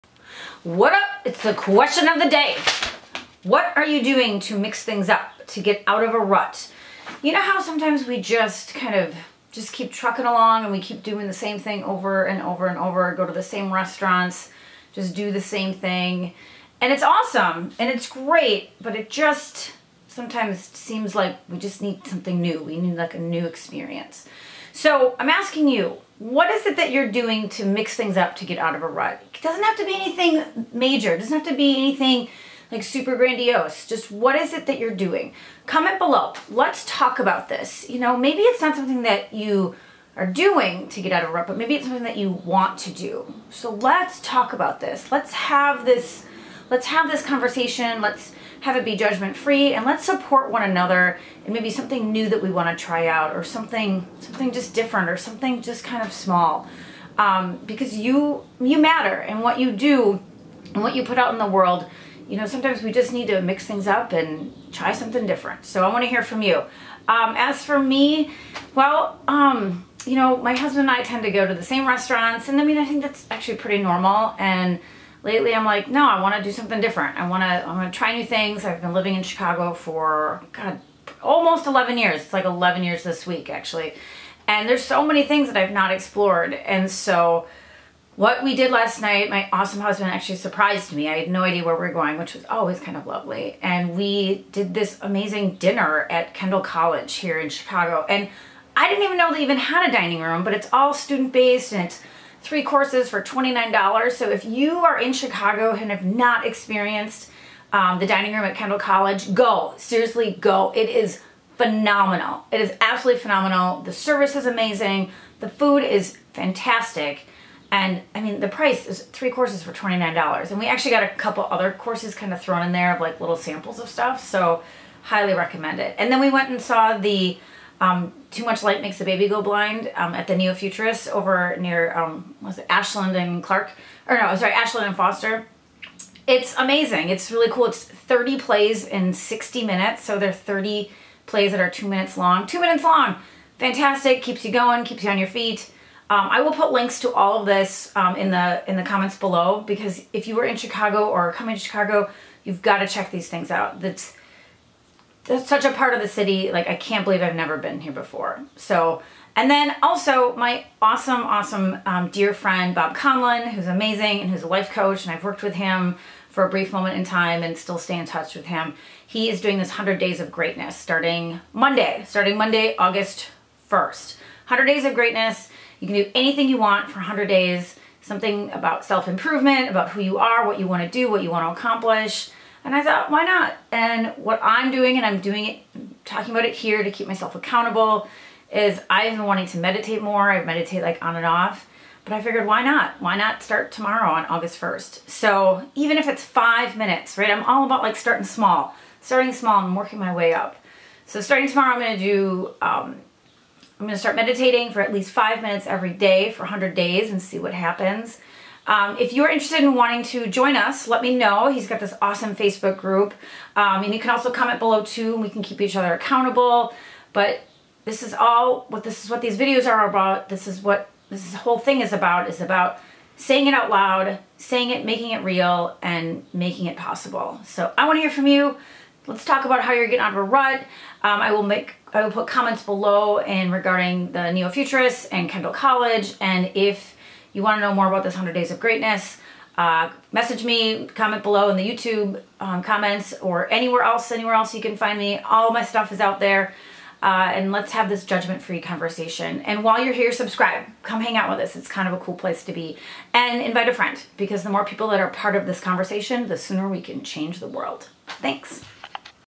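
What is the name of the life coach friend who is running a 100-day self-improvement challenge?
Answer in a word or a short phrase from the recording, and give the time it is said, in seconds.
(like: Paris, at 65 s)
Bob Conlin, at 162 s.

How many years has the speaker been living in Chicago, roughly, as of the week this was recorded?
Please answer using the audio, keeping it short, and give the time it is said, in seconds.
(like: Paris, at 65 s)
11, at 81 s.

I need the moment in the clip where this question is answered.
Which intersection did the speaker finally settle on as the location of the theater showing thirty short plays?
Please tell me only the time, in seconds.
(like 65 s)
134 s.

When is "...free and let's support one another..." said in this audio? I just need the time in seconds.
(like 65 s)
49 s.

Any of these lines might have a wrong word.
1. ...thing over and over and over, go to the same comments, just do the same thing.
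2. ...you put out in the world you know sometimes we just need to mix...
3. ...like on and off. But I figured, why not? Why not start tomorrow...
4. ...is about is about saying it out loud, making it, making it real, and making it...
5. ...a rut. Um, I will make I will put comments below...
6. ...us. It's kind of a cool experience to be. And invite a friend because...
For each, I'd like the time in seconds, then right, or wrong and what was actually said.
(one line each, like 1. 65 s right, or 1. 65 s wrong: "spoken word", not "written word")
1. 11 s wrong: "restaurants", not "comments"
2. 60 s right
3. 190 s right
4. 221 s wrong: "saying", not "making"
5. 230 s right
6. 251 s wrong: "place", not "experience".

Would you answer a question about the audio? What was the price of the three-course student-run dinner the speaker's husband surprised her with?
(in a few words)
$29.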